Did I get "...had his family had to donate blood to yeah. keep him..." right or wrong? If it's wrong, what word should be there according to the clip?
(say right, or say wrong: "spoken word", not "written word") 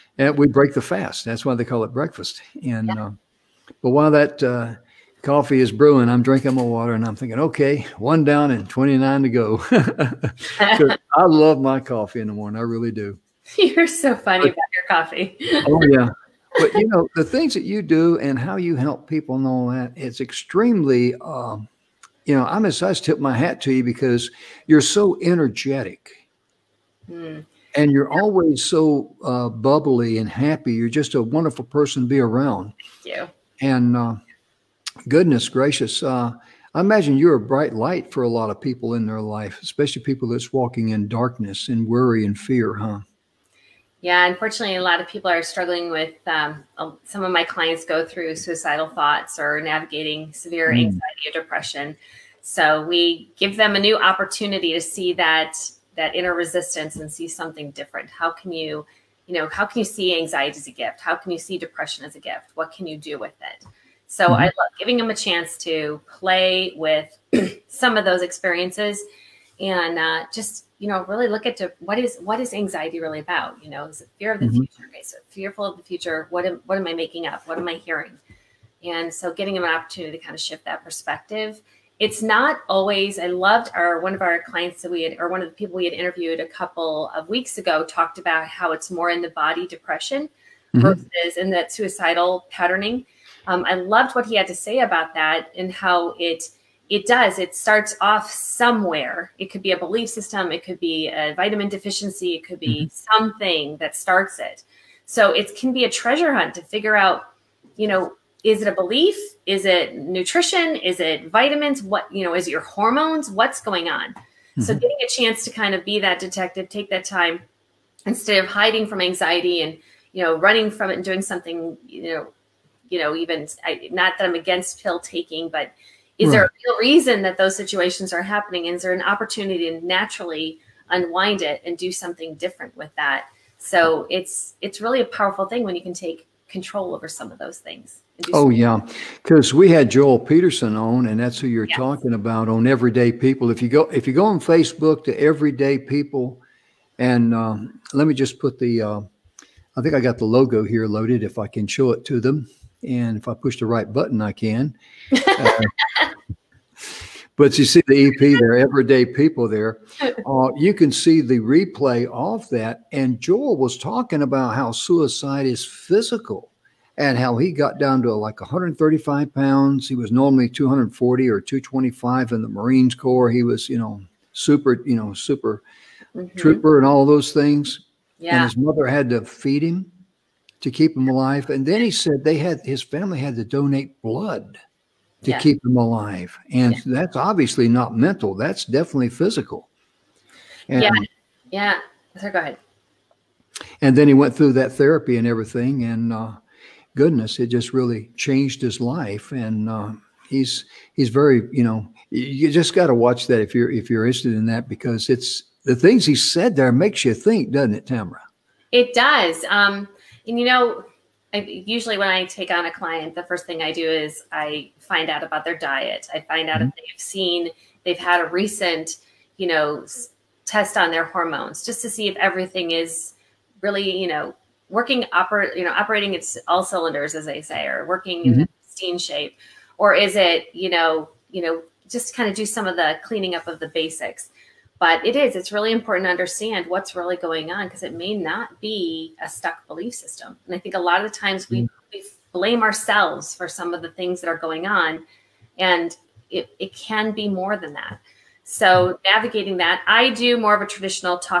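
right.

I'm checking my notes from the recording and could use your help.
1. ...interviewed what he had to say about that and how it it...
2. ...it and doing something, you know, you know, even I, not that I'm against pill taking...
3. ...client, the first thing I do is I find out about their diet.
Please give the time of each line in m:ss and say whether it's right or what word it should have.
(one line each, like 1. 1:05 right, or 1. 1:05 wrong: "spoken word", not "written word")
1. 1:33 wrong: "loved", not "interviewed"
2. 2:00 right
3. 3:32 right.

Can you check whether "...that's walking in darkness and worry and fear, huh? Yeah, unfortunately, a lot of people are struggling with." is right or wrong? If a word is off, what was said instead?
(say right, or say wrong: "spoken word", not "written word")
right.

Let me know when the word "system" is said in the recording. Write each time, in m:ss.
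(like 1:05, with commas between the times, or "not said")
1:40, 3:59.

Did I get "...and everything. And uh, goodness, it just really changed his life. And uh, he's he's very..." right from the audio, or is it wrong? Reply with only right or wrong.
right.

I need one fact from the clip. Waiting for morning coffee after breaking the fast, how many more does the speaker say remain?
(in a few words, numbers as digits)
29.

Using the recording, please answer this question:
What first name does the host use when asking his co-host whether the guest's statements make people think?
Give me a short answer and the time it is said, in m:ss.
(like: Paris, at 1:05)
Tamara, at 3:27.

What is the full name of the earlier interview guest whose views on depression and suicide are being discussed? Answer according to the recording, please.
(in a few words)
Joel Peterson.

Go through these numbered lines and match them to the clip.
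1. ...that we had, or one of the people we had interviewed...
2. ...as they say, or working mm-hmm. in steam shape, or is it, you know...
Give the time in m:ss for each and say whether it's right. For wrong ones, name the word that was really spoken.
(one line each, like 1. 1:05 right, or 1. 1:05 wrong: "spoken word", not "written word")
1. 1:24 right
2. 3:47 right.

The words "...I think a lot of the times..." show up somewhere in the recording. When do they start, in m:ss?
4:00.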